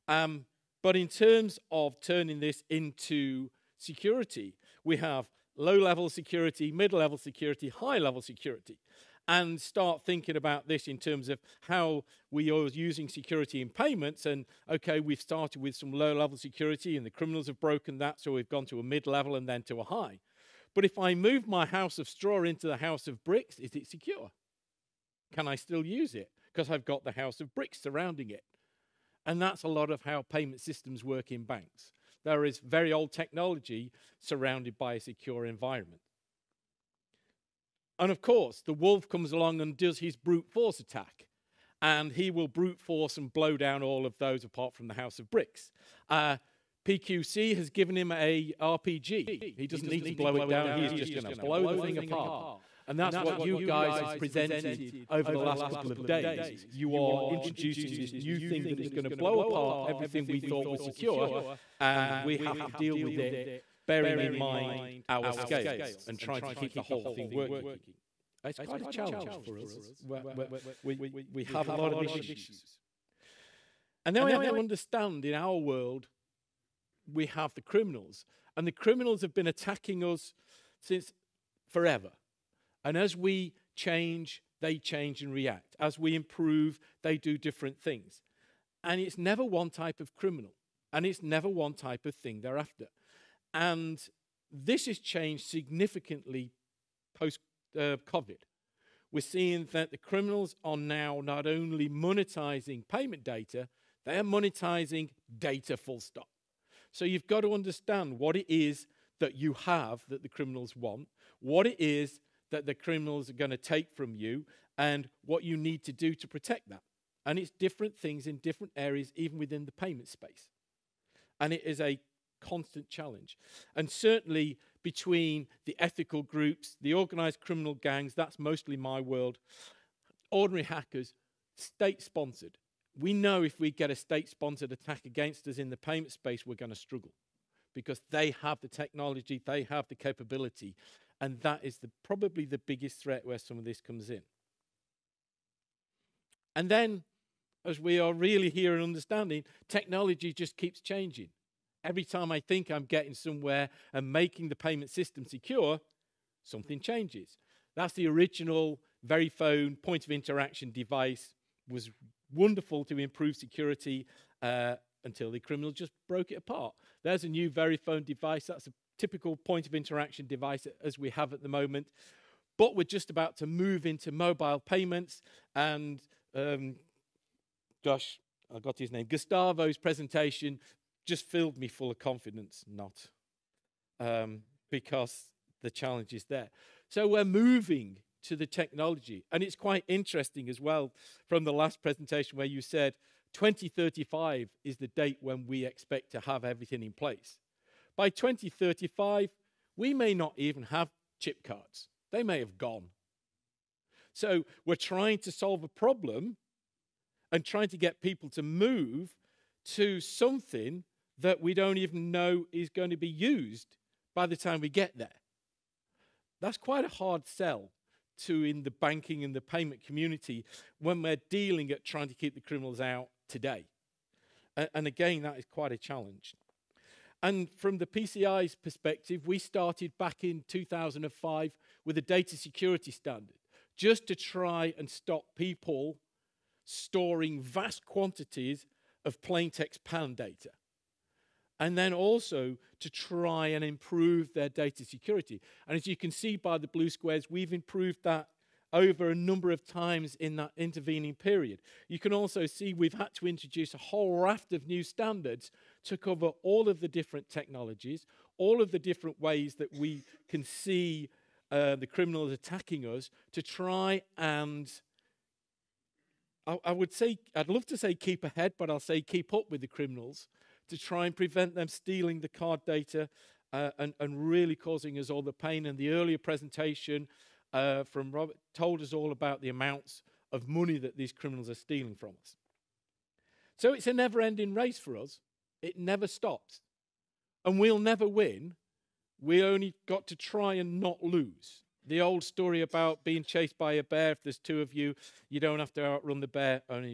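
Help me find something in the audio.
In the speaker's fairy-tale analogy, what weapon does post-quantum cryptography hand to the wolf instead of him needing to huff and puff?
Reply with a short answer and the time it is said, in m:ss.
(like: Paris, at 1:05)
RPG, at 0:48.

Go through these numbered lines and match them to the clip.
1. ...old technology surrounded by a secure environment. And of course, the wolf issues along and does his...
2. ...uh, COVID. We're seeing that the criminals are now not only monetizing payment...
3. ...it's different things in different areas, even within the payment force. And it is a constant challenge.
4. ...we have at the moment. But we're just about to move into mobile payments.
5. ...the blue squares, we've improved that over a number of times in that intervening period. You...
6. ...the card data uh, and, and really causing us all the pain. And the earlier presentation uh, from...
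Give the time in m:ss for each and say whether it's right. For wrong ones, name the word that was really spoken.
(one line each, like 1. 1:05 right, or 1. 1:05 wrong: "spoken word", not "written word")
1. 0:32 wrong: "comes", not "issues"
2. 1:37 right
3. 1:57 wrong: "space", not "force"
4. 2:50 right
5. 4:06 right
6. 4:32 right.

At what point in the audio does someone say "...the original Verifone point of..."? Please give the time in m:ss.
2:37.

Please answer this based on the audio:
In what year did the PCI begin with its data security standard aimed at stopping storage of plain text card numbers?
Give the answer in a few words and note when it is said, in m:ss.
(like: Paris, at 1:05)
2005, at 3:50.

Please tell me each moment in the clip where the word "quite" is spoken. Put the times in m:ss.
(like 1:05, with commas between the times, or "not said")
1:08, 3:09, 3:36, 3:45.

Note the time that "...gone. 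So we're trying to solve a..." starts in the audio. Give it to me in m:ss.
3:22.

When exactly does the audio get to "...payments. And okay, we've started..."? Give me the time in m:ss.
0:13.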